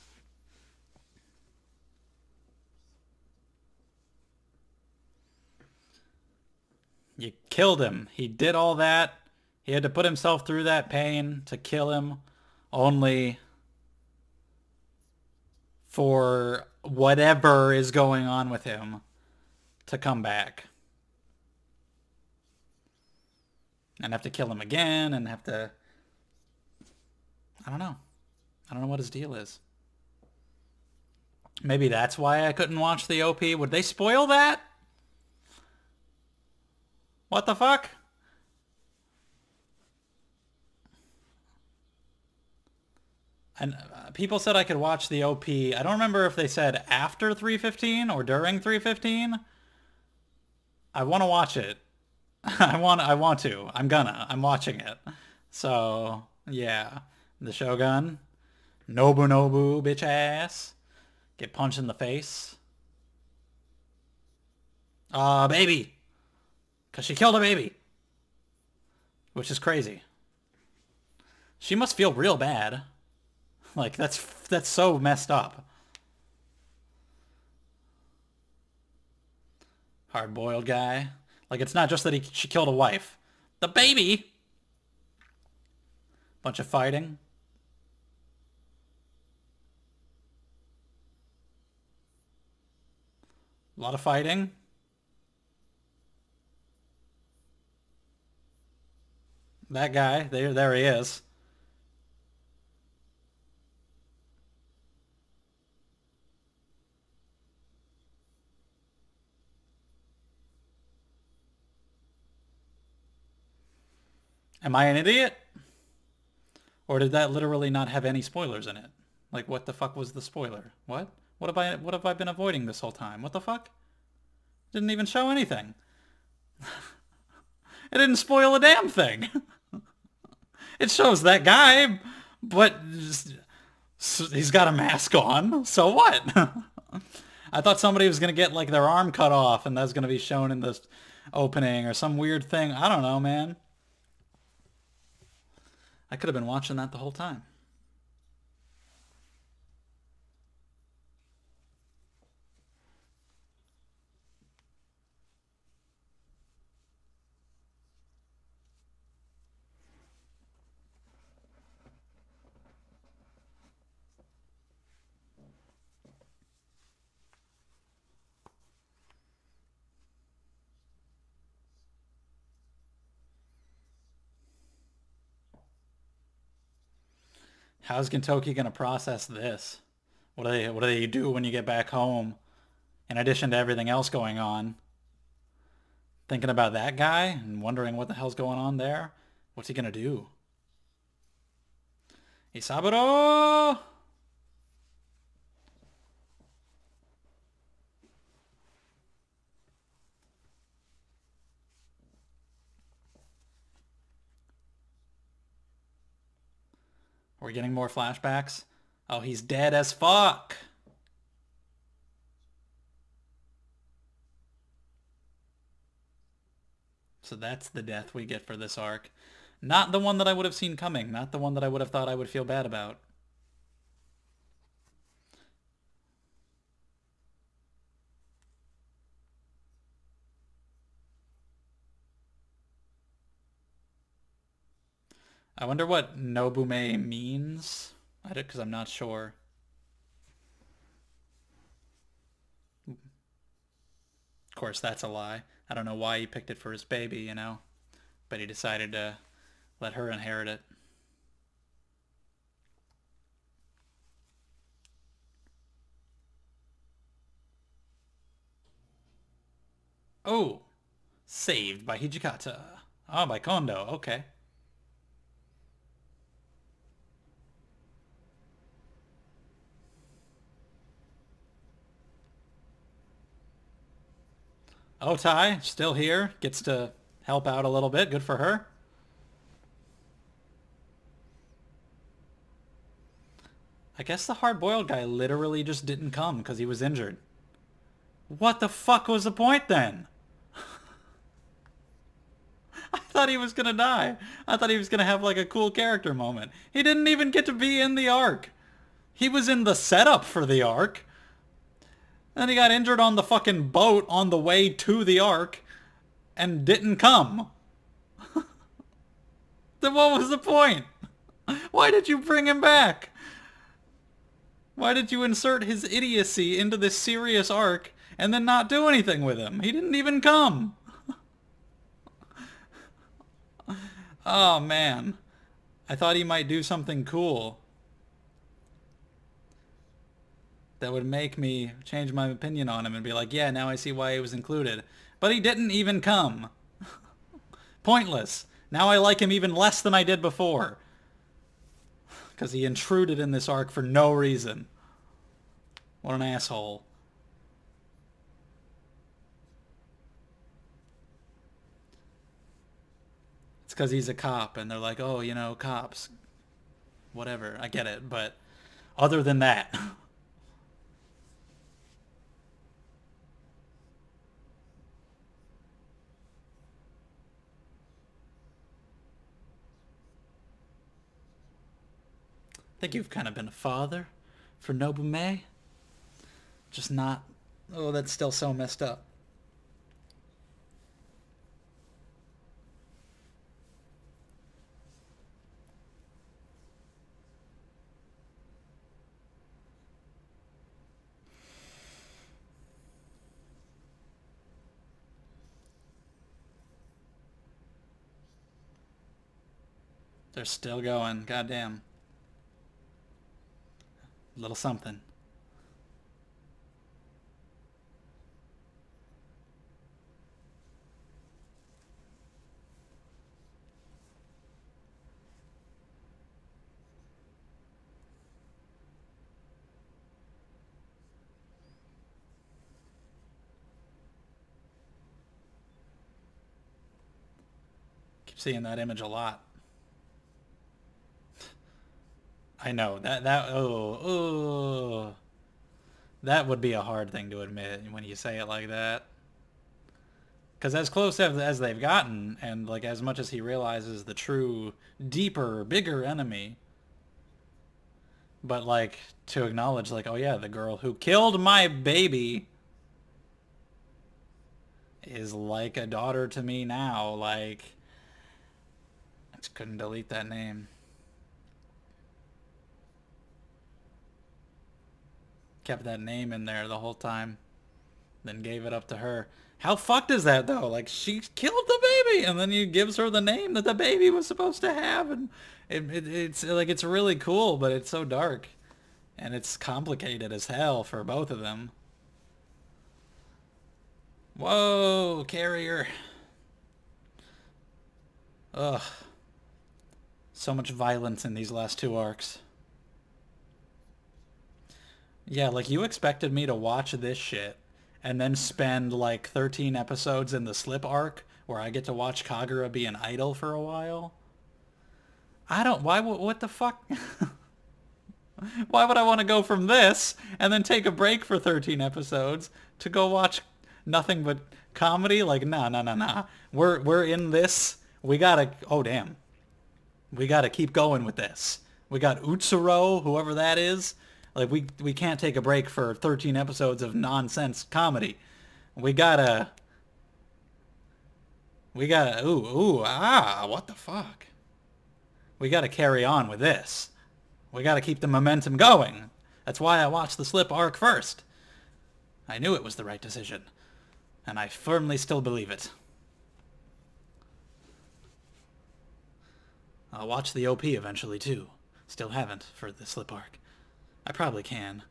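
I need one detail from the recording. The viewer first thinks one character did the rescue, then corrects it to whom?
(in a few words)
Kondo.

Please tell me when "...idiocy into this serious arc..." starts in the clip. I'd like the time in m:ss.
5:15.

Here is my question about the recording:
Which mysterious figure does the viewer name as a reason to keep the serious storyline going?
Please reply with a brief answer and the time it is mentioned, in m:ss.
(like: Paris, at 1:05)
Utsuro, at 8:42.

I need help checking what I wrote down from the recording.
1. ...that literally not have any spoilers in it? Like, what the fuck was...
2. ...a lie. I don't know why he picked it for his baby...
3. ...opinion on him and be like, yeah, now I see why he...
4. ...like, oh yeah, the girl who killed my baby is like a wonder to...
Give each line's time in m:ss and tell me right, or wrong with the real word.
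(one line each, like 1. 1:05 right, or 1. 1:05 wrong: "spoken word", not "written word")
1. 1:57 right
2. 4:05 right
3. 5:32 right
4. 7:29 wrong: "daughter", not "wonder".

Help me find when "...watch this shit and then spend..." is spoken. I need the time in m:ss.
8:16.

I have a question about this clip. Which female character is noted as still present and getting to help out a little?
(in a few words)
Otai.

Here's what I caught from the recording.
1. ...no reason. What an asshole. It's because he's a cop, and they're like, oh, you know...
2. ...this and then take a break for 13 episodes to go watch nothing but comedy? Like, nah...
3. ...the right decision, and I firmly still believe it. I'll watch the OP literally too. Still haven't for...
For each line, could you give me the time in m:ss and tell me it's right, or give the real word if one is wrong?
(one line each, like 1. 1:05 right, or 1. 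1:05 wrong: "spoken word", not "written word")
1. 5:43 right
2. 8:29 right
3. 9:02 wrong: "eventually", not "literally".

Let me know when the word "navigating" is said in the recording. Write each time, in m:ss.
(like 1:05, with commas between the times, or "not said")
not said.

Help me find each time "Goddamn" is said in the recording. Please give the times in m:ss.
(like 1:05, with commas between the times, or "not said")
6:41.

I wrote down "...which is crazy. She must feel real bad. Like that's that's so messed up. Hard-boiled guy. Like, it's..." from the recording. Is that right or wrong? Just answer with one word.
right.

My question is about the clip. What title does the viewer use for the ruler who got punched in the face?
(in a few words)
Shogun.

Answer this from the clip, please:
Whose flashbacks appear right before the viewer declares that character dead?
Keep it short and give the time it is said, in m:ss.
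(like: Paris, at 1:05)
Isaburo, at 3:12.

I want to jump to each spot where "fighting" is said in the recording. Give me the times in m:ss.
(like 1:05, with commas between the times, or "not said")
1:26, 1:34.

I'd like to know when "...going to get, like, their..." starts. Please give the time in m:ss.
2:18.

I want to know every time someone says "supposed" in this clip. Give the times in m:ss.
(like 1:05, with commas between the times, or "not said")
7:54.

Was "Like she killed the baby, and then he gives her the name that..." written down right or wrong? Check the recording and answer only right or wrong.
right.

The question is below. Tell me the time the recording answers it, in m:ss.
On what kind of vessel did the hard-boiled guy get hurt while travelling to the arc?
5:03.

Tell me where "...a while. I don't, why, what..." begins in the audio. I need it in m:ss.
8:23.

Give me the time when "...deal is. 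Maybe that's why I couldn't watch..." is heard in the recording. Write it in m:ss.
0:29.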